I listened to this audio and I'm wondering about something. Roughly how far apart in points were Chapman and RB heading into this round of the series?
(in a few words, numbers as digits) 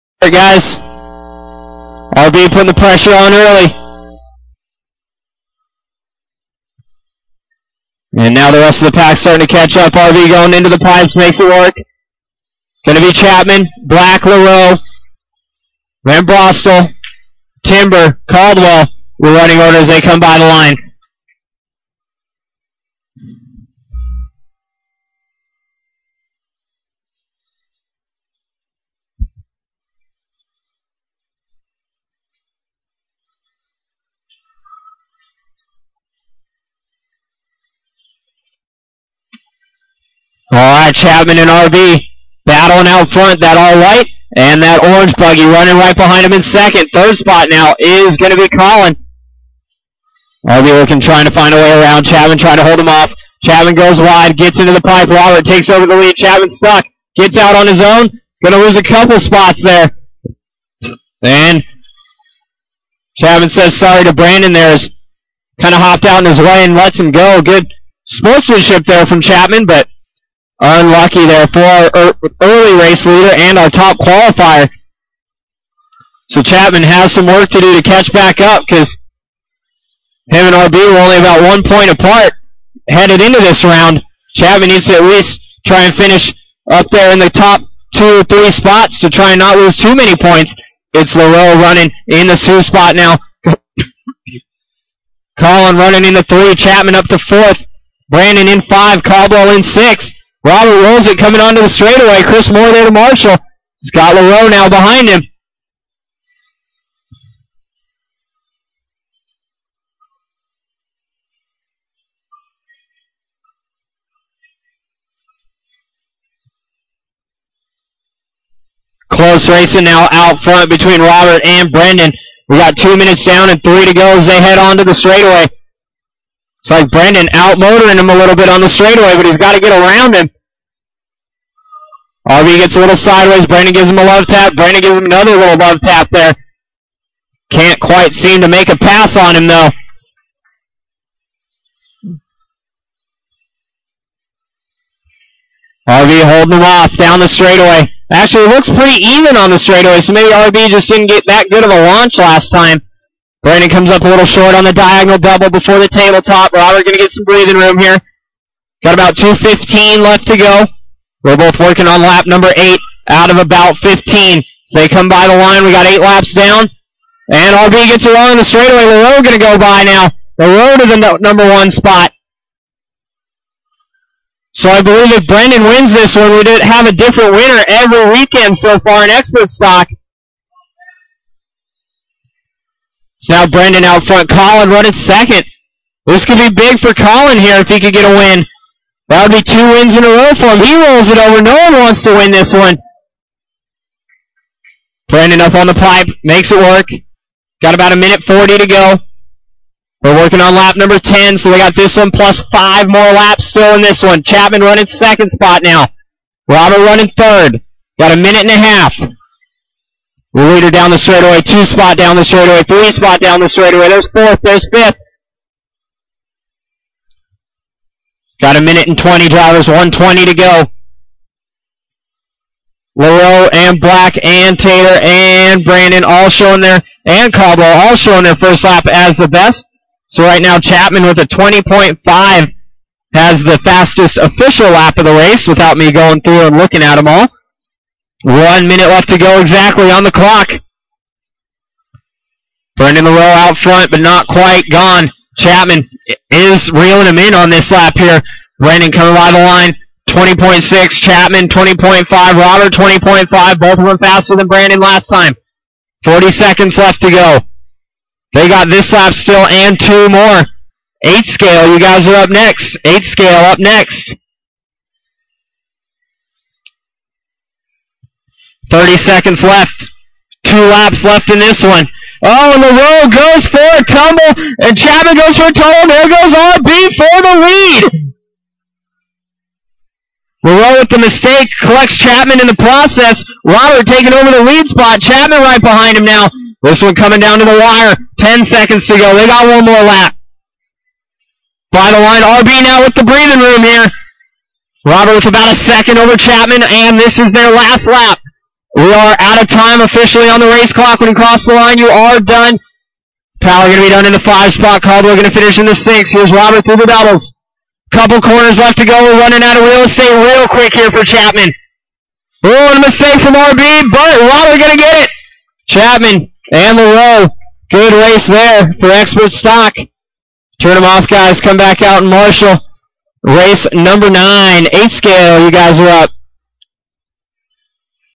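1 point.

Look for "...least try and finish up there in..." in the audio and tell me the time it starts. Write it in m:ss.
1:25.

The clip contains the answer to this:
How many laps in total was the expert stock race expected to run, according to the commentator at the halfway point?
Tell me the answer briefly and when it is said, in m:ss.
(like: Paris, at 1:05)
15, at 2:43.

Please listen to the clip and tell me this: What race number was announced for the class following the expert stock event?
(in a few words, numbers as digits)
9.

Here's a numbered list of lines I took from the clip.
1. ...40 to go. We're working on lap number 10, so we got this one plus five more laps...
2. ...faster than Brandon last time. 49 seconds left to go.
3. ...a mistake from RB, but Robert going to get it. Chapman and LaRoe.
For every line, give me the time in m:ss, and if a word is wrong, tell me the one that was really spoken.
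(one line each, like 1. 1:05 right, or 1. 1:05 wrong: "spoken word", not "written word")
1. 3:18 right
2. 4:13 wrong: "40", not "49"
3. 5:12 right.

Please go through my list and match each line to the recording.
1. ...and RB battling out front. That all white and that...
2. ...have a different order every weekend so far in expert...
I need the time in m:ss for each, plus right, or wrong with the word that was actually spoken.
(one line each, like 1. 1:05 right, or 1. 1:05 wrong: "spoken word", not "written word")
1. 0:41 right
2. 2:56 wrong: "winner", not "order".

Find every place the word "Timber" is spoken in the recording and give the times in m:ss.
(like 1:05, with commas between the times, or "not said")
0:17.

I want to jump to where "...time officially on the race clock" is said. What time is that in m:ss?
4:59.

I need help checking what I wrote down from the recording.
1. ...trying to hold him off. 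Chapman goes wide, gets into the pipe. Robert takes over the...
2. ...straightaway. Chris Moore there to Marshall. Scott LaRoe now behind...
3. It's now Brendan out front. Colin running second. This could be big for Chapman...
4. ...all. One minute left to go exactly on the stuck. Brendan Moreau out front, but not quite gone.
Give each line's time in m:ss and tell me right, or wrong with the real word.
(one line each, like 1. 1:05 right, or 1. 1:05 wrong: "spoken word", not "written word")
1. 0:52 right
2. 1:41 right
3. 3:03 wrong: "Colin", not "Chapman"
4. 3:57 wrong: "clock", not "stuck".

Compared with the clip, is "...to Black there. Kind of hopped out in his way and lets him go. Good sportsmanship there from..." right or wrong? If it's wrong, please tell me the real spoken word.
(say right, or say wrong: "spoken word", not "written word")
wrong: "Brandon", not "Black".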